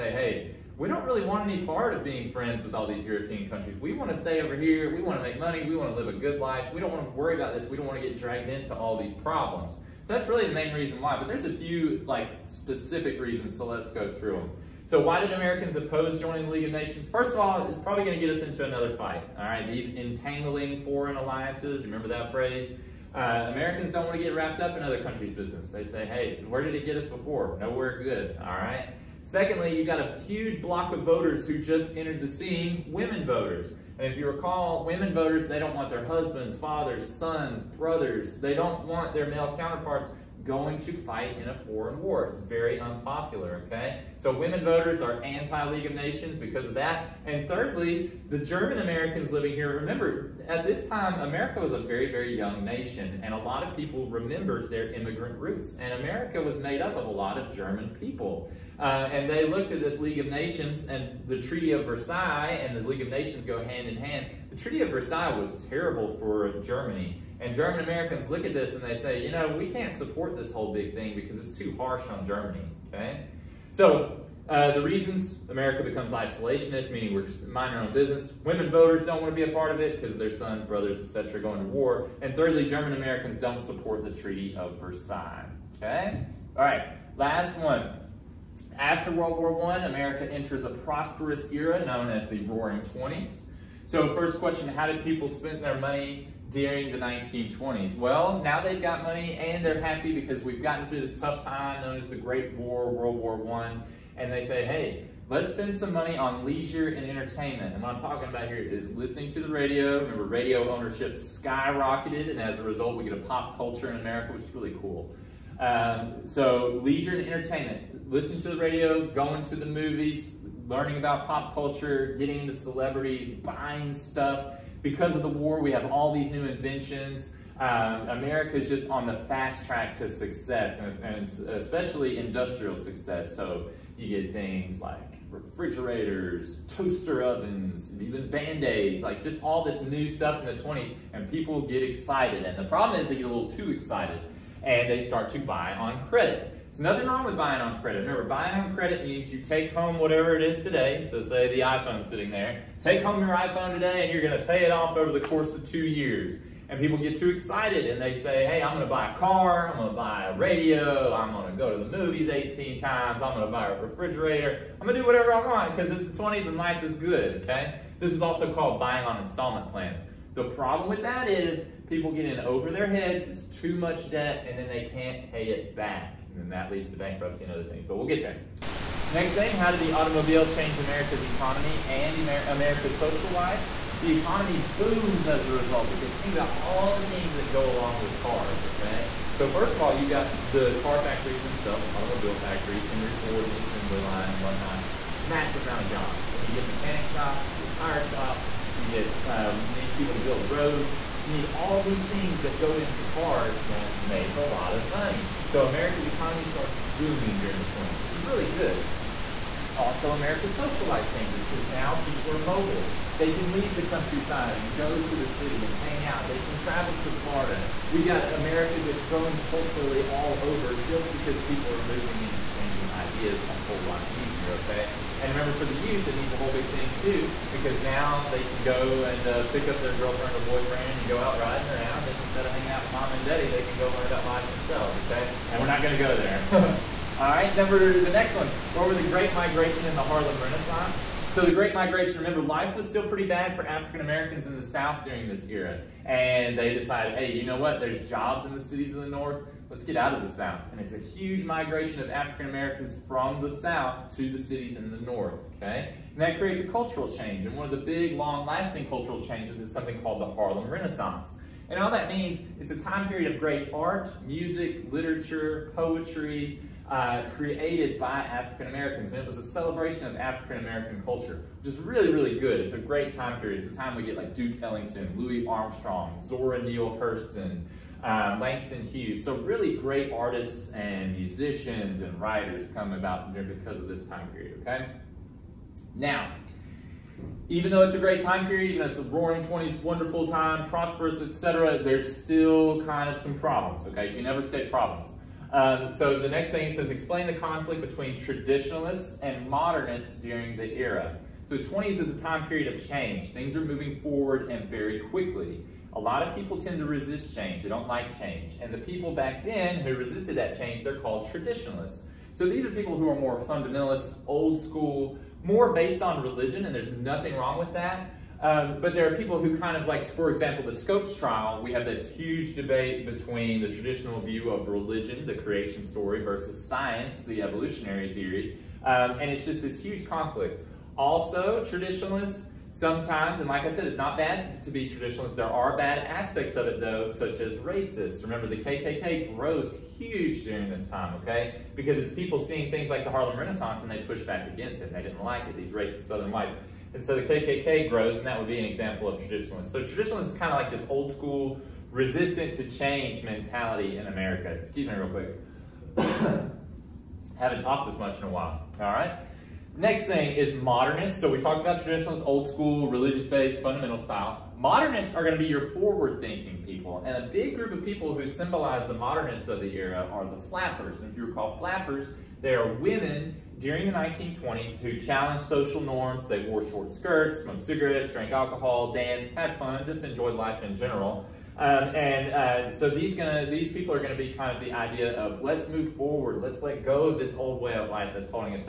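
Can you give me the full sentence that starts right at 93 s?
So first question, how did people spend their money during the 1920s?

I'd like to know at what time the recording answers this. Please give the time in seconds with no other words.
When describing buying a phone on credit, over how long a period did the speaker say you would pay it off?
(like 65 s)
155 s.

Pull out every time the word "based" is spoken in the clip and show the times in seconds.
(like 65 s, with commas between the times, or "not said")
315 s, 362 s.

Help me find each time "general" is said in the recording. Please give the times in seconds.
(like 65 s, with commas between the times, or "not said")
380 s.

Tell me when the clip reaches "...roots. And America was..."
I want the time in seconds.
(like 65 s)
55 s.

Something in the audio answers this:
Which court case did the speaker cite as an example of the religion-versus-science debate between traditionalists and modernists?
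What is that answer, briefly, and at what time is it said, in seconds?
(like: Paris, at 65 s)
Scopes trial, at 320 s.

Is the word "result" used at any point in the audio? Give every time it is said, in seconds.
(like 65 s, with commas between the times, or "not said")
112 s, 185 s.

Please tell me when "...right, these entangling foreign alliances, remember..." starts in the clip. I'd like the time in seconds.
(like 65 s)
19 s.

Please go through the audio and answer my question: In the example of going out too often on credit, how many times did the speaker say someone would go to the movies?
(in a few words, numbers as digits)
18.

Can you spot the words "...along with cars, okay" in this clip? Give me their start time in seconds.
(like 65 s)
187 s.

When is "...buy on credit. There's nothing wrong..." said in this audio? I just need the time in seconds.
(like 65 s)
145 s.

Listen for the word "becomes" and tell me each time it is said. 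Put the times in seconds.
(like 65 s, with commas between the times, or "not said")
75 s.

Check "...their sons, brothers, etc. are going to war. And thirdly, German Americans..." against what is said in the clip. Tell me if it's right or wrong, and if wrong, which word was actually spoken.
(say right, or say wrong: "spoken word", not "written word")
right.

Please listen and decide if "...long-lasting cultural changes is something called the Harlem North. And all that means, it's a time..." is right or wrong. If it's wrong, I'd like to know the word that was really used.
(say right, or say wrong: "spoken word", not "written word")
wrong: "Renaissance", not "North".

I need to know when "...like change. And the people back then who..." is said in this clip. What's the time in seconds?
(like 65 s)
307 s.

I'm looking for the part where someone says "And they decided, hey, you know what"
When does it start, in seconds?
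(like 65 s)
246 s.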